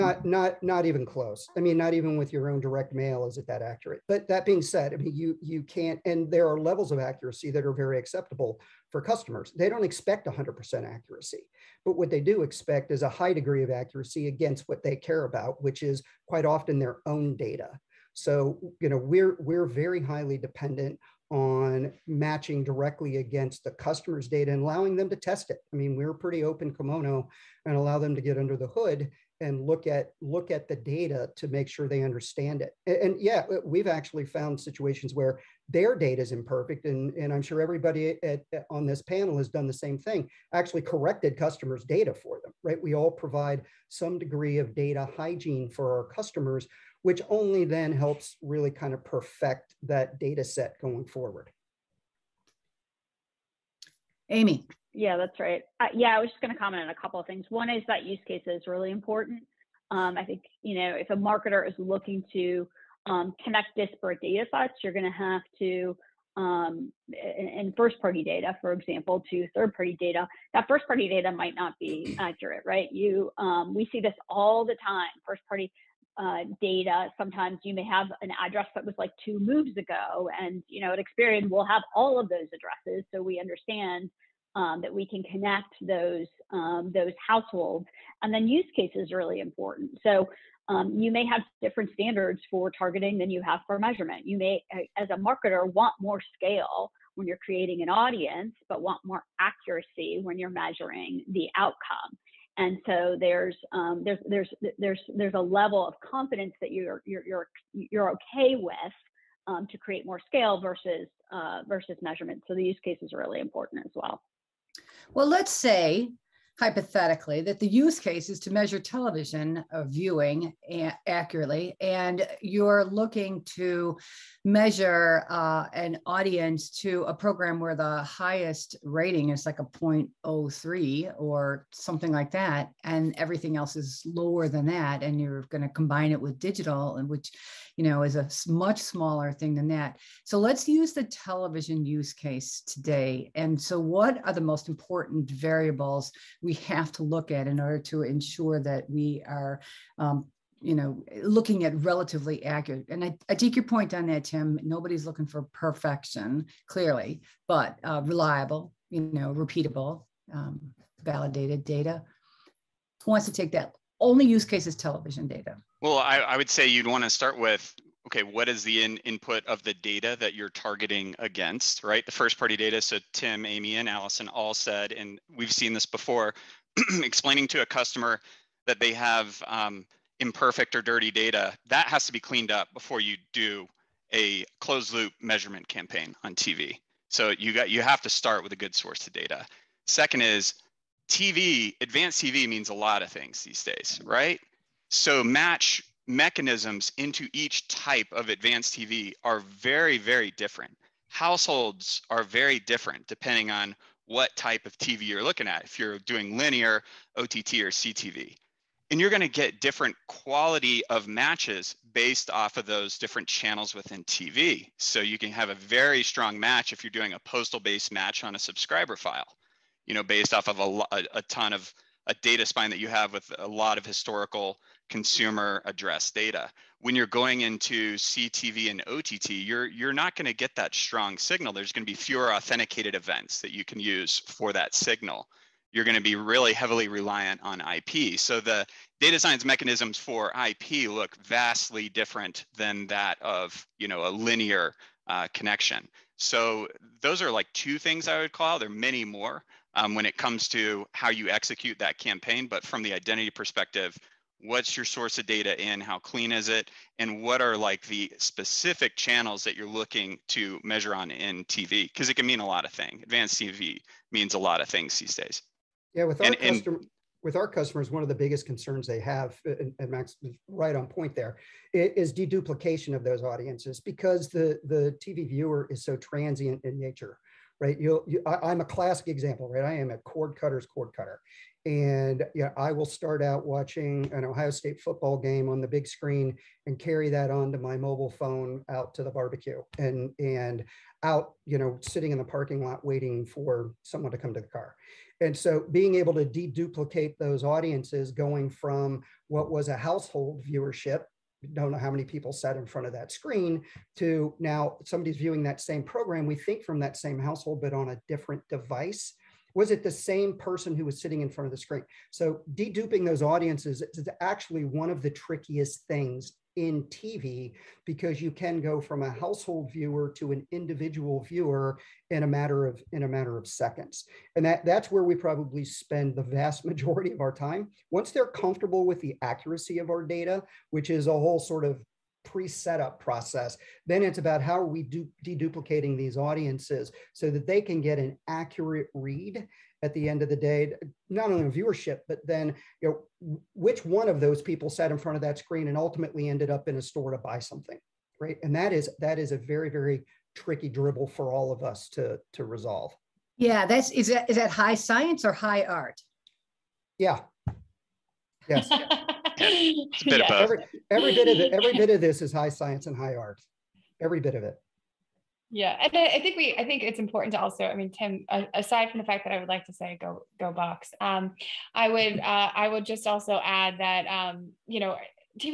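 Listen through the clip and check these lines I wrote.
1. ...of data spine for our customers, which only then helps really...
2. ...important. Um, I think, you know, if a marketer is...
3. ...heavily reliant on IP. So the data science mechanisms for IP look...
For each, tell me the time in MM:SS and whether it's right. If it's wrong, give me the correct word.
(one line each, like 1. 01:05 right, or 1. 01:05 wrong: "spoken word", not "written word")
1. 00:44 wrong: "hygiene", not "spine"
2. 00:58 right
3. 03:56 right.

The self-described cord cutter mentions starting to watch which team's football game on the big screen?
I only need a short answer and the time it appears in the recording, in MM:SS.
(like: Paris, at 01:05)
Ohio State, at 04:44.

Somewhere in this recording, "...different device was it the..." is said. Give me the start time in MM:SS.
05:08.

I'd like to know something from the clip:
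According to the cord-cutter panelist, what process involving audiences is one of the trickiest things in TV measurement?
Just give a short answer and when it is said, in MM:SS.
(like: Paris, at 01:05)
deduplication, at 04:32.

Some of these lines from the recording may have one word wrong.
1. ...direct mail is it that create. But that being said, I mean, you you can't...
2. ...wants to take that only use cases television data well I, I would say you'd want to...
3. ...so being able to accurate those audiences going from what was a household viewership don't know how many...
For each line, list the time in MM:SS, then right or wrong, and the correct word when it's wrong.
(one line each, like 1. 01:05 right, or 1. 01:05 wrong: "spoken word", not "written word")
1. 00:02 wrong: "accurate", not "create"
2. 02:43 right
3. 04:55 wrong: "deduplicate", not "accurate".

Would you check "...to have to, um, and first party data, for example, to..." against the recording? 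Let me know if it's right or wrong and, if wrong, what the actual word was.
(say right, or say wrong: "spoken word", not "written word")
right.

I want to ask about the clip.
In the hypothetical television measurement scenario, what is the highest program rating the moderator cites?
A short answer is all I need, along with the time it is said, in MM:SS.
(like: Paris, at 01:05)
0.03, at 02:09.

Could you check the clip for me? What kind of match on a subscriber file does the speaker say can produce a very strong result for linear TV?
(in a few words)
postal based match.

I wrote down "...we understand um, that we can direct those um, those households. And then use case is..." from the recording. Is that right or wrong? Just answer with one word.
wrong.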